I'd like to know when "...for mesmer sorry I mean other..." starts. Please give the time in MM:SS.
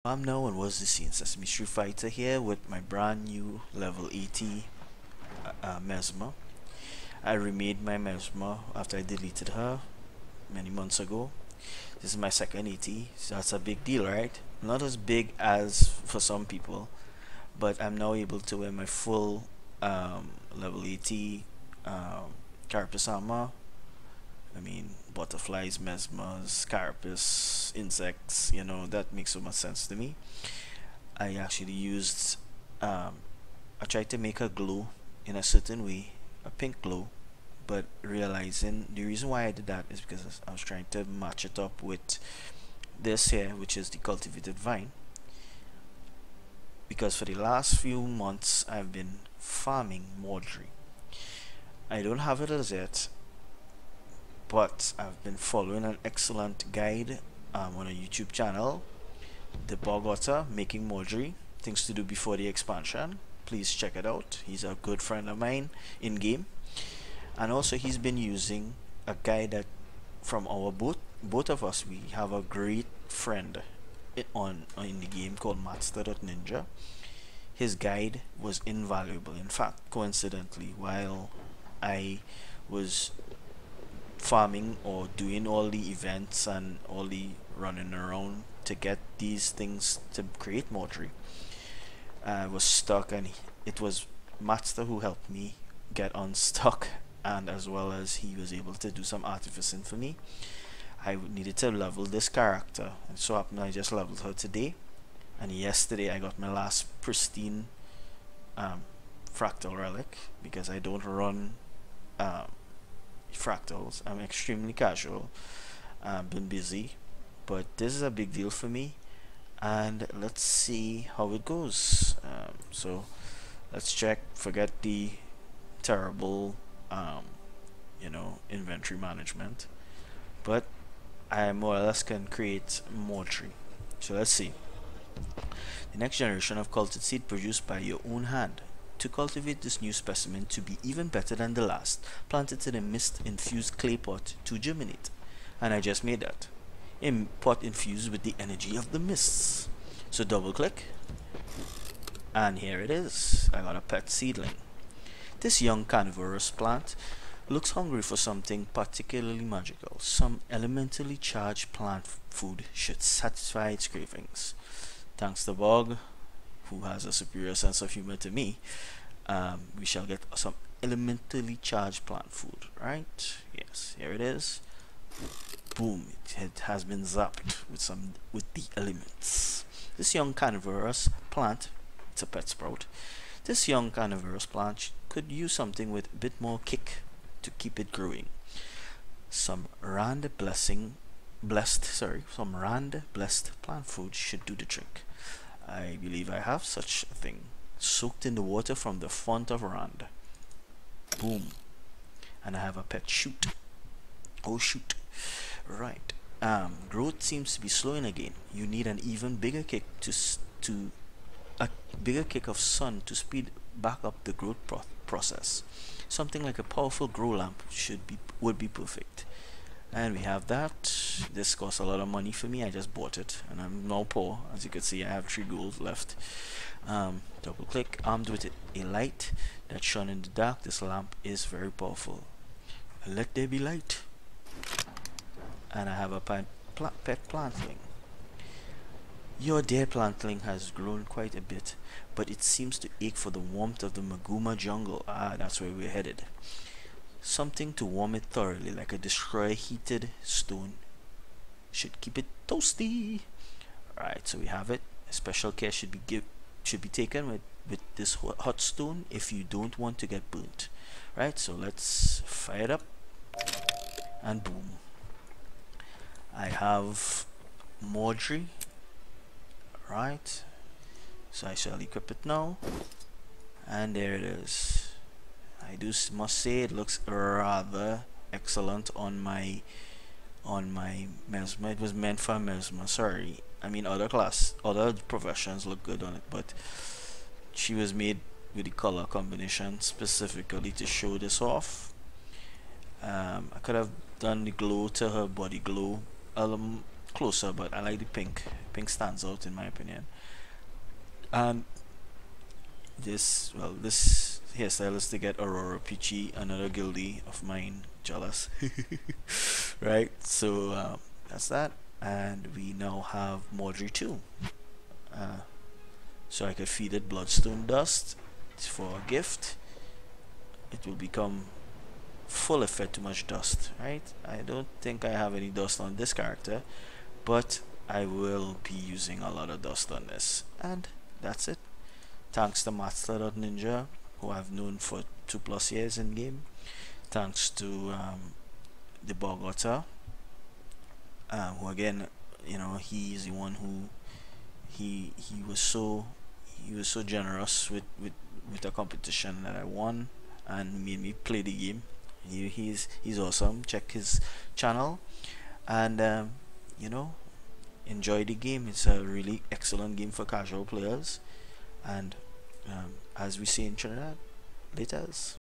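04:42.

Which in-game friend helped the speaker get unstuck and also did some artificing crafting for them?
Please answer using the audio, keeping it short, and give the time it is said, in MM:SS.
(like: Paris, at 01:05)
Mattsta, at 01:34.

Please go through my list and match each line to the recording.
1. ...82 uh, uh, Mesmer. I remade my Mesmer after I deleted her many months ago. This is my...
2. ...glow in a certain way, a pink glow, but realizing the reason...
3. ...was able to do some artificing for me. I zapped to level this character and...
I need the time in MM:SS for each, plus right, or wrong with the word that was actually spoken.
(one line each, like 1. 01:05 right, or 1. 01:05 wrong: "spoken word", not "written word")
1. 00:04 wrong: "80", not "82"
2. 00:34 right
3. 01:38 wrong: "needed", not "zapped".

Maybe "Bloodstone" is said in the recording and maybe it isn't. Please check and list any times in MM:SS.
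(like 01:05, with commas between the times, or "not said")
05:17.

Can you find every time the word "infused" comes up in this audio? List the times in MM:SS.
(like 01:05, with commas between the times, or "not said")
02:22, 02:27.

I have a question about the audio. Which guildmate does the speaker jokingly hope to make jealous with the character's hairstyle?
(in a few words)
Aurora Peachy.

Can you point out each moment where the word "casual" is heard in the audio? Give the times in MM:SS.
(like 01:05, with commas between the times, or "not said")
01:54, 06:00.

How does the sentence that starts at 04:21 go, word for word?
Right, so let's fire it up and boom.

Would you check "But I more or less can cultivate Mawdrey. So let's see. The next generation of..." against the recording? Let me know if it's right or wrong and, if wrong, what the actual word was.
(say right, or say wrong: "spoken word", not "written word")
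wrong: "create", not "cultivate".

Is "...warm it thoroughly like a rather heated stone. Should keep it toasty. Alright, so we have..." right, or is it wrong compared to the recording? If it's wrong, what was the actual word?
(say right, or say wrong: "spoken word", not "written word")
wrong: "destroyer", not "rather".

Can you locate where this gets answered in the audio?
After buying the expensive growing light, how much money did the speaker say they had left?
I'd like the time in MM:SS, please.
03:45.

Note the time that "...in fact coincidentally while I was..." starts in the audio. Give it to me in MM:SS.
01:19.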